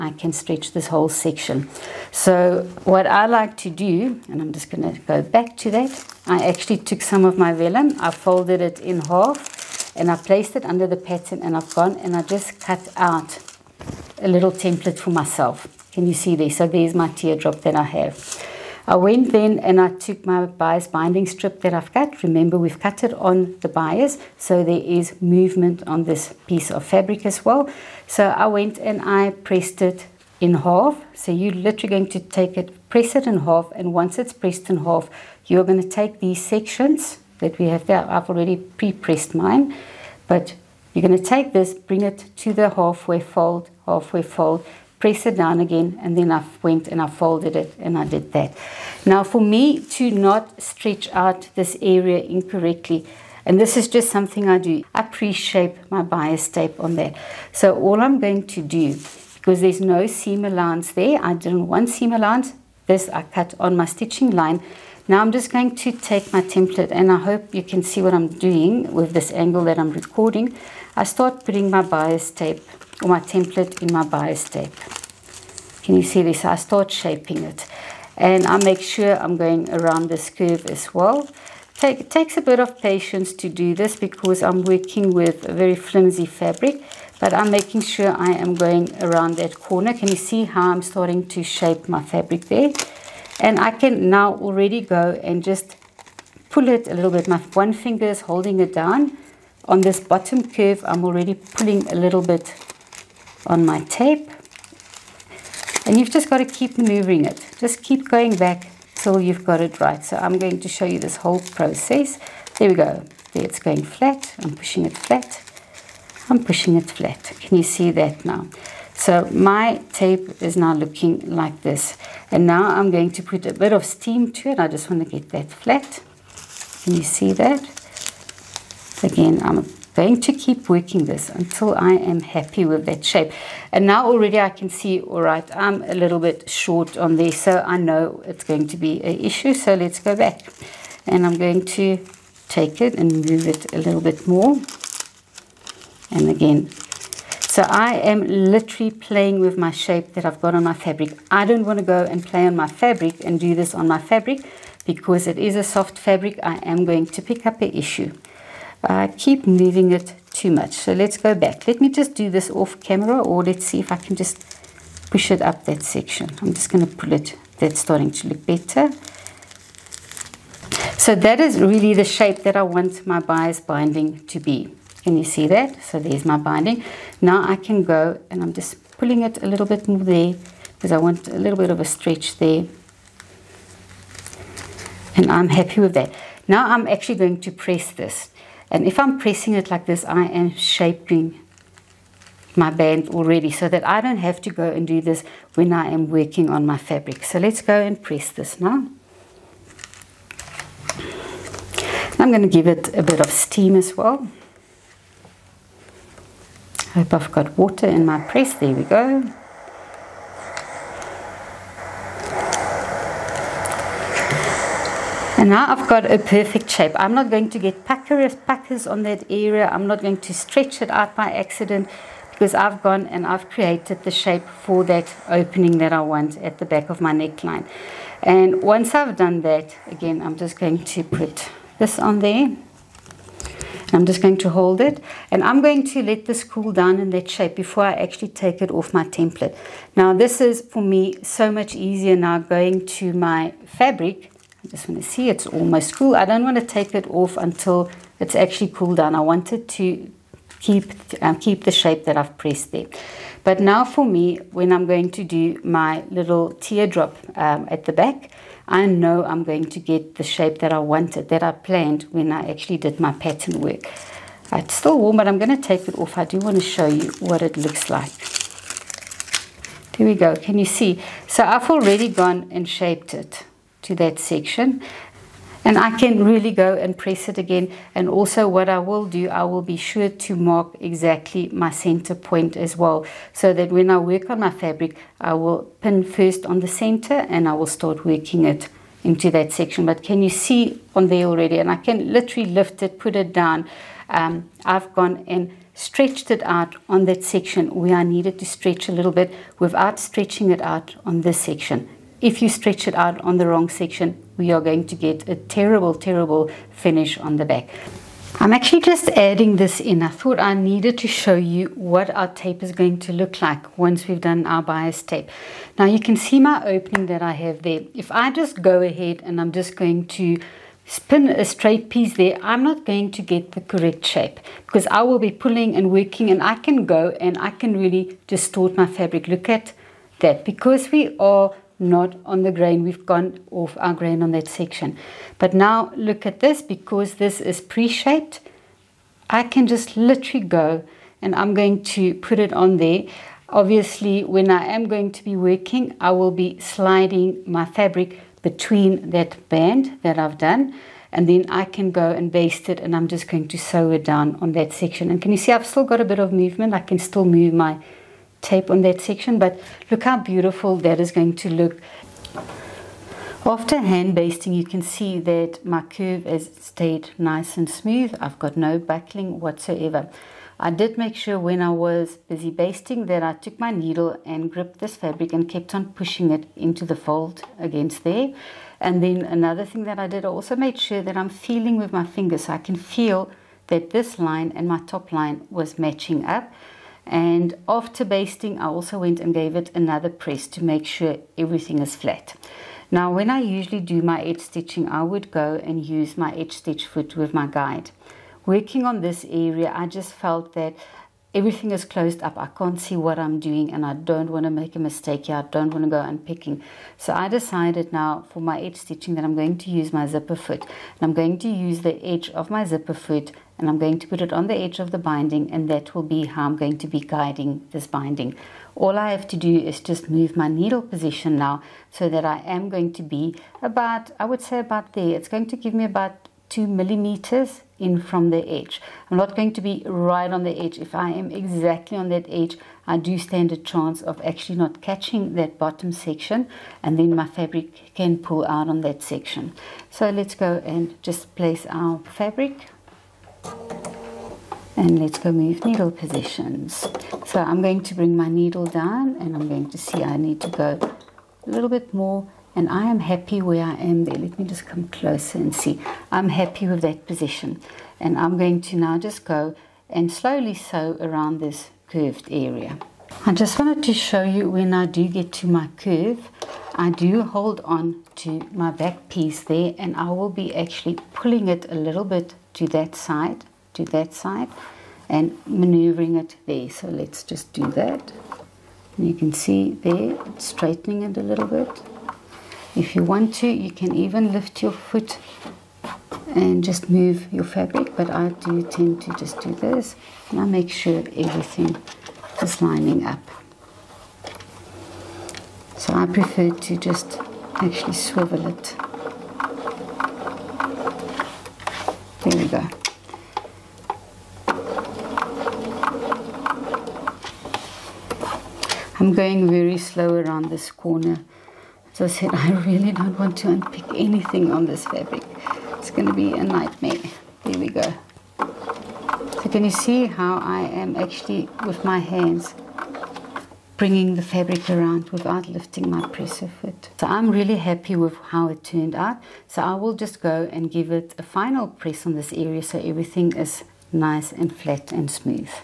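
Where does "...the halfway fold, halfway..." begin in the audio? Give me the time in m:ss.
0:42.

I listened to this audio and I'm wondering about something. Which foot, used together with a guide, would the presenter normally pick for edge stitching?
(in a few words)
edge stitch foot.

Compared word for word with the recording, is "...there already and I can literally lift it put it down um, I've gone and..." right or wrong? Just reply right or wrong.
right.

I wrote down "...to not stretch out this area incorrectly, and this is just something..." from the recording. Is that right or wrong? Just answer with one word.
right.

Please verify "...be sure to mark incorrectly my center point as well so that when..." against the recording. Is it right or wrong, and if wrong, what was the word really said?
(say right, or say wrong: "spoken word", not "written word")
wrong: "exactly", not "incorrectly".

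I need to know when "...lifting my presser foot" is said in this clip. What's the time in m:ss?
8:45.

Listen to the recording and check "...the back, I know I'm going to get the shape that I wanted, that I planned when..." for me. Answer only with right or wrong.
right.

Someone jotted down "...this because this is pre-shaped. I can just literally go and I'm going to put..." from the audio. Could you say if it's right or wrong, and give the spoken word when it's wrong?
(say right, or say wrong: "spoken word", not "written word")
right.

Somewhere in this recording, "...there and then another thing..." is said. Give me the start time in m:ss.
6:18.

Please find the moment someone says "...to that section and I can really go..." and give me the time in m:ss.
4:33.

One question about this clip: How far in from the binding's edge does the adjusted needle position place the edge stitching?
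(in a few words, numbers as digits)
2 millimeters.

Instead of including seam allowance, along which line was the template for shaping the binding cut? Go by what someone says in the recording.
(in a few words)
stitching line.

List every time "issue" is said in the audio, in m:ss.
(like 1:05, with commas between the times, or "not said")
2:19, 2:37.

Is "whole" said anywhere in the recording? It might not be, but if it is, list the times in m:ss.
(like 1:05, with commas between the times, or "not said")
0:00, 1:51.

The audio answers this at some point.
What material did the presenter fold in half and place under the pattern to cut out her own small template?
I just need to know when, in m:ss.
0:07.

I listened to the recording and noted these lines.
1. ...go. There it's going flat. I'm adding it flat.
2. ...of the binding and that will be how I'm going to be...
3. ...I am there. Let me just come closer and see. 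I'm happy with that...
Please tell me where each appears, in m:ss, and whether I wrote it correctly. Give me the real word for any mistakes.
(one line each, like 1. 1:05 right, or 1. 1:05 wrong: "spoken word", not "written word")
1. 1:52 wrong: "pushing", not "adding"
2. 6:54 right
3. 7:33 right.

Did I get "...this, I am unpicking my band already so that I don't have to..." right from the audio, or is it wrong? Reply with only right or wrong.
wrong.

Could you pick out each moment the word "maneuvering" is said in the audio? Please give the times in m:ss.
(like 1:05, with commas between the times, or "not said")
1:46, 7:55.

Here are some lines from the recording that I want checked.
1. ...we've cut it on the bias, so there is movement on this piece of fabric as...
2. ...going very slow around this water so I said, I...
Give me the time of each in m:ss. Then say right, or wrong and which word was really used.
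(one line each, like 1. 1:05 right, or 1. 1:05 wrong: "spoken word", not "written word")
1. 0:22 right
2. 8:29 wrong: "corner", not "water".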